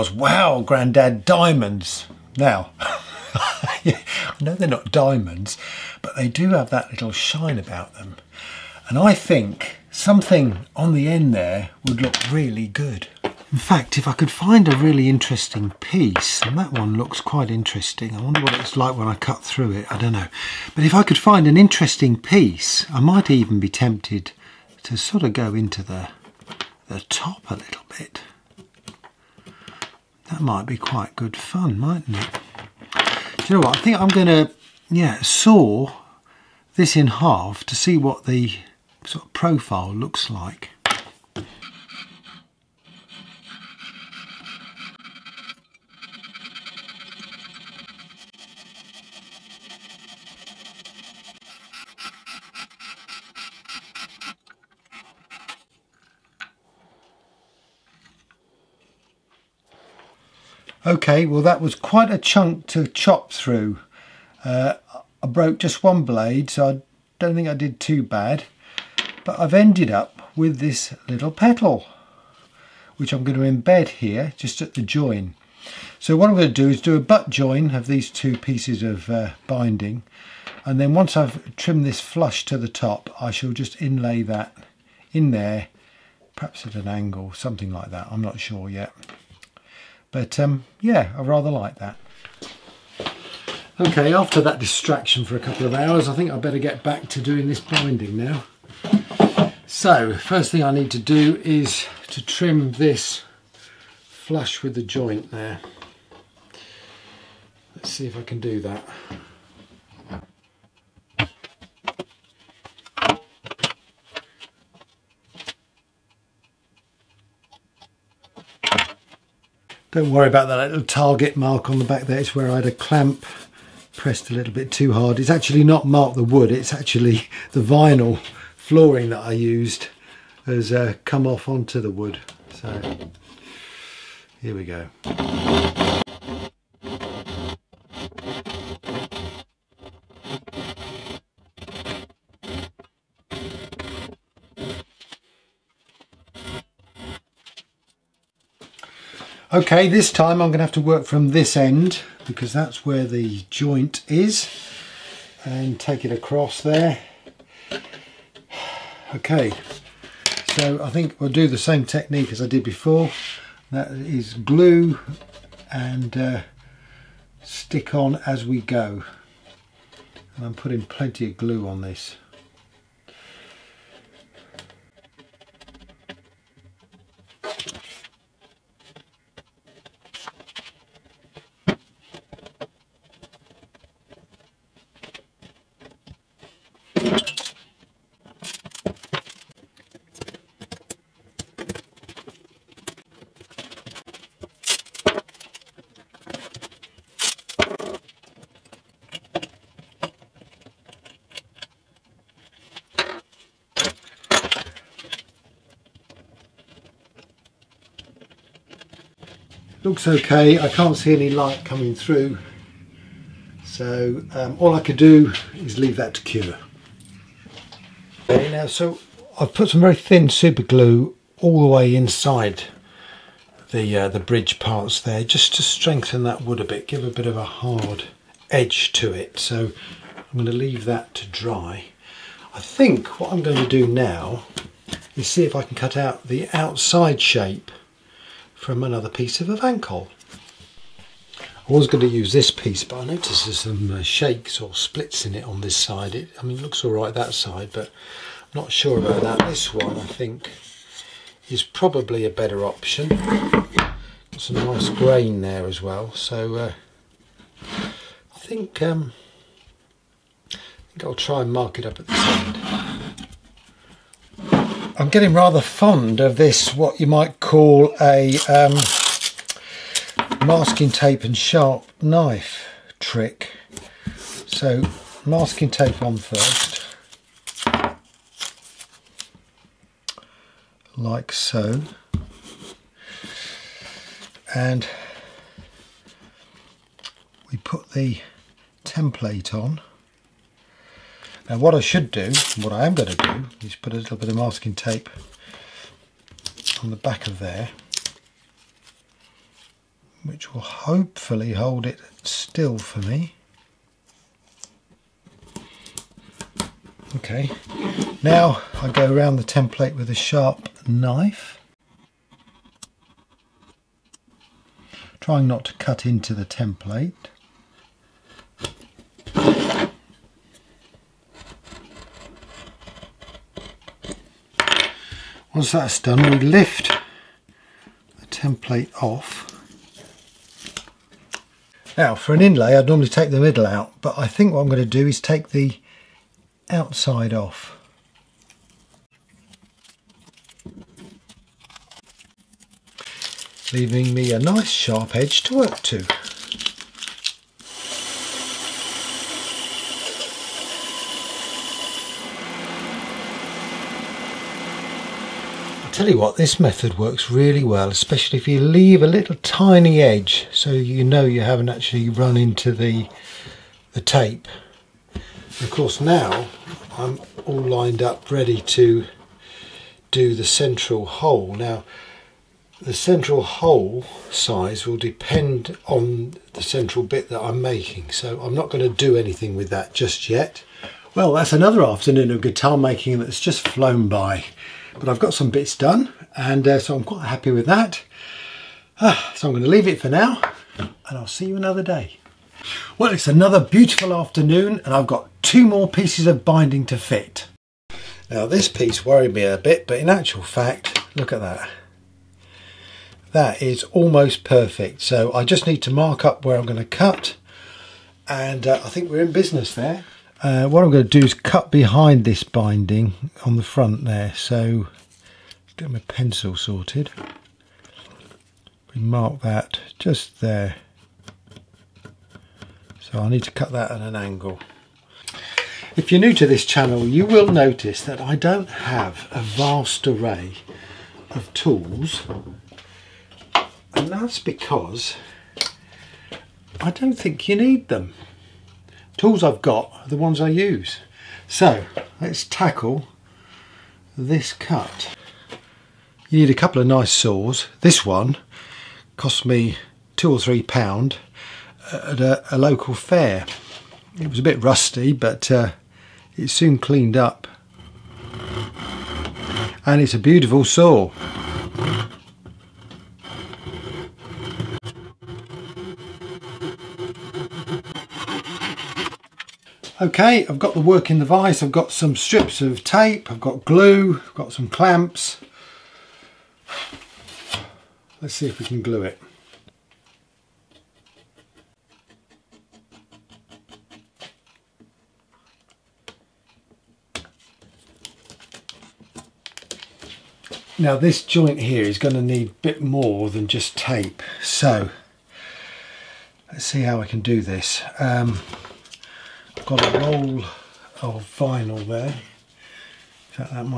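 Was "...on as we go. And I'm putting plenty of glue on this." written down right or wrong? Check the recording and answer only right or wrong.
right.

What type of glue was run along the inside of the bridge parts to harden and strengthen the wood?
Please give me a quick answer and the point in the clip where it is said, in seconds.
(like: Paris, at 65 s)
thin super glue, at 219 s.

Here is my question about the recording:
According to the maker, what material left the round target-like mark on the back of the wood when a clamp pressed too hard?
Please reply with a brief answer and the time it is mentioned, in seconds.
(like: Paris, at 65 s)
vinyl flooring, at 127 s.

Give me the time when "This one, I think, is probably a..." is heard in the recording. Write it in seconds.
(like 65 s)
249 s.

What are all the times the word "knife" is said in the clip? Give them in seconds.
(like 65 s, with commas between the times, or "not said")
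272 s, 310 s.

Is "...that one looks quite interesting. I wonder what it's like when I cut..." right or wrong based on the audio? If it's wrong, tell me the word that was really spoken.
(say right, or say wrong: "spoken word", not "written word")
right.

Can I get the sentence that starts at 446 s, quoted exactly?
You need a couple of nice saws.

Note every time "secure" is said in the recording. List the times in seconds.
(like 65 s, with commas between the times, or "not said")
not said.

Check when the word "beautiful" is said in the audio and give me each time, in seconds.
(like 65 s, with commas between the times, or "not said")
393 s, 460 s.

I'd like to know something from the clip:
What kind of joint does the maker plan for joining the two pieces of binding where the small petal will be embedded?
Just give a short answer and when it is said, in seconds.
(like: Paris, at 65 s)
butt join, at 77 s.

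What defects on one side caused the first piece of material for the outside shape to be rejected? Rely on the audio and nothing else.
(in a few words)
shakes or splits.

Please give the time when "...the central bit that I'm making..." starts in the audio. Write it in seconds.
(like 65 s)
376 s.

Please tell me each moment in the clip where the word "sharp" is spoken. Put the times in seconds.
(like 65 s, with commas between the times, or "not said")
271 s, 310 s, 344 s.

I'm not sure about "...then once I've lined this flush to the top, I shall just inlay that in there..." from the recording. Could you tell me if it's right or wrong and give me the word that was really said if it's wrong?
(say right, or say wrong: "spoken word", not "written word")
wrong: "trimmed", not "lined".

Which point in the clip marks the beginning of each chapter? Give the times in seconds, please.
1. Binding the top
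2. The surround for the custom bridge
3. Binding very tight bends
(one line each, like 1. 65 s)
1. 95 s
2. 215 s
3. 380 s.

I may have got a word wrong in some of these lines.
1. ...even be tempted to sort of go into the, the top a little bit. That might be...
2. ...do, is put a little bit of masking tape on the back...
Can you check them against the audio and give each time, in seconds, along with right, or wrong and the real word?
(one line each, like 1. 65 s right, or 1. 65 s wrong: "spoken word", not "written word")
1. 23 s right
2. 293 s right.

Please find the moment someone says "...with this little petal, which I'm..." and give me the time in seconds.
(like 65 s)
70 s.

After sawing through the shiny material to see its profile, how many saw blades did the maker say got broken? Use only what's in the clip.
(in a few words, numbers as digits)
1.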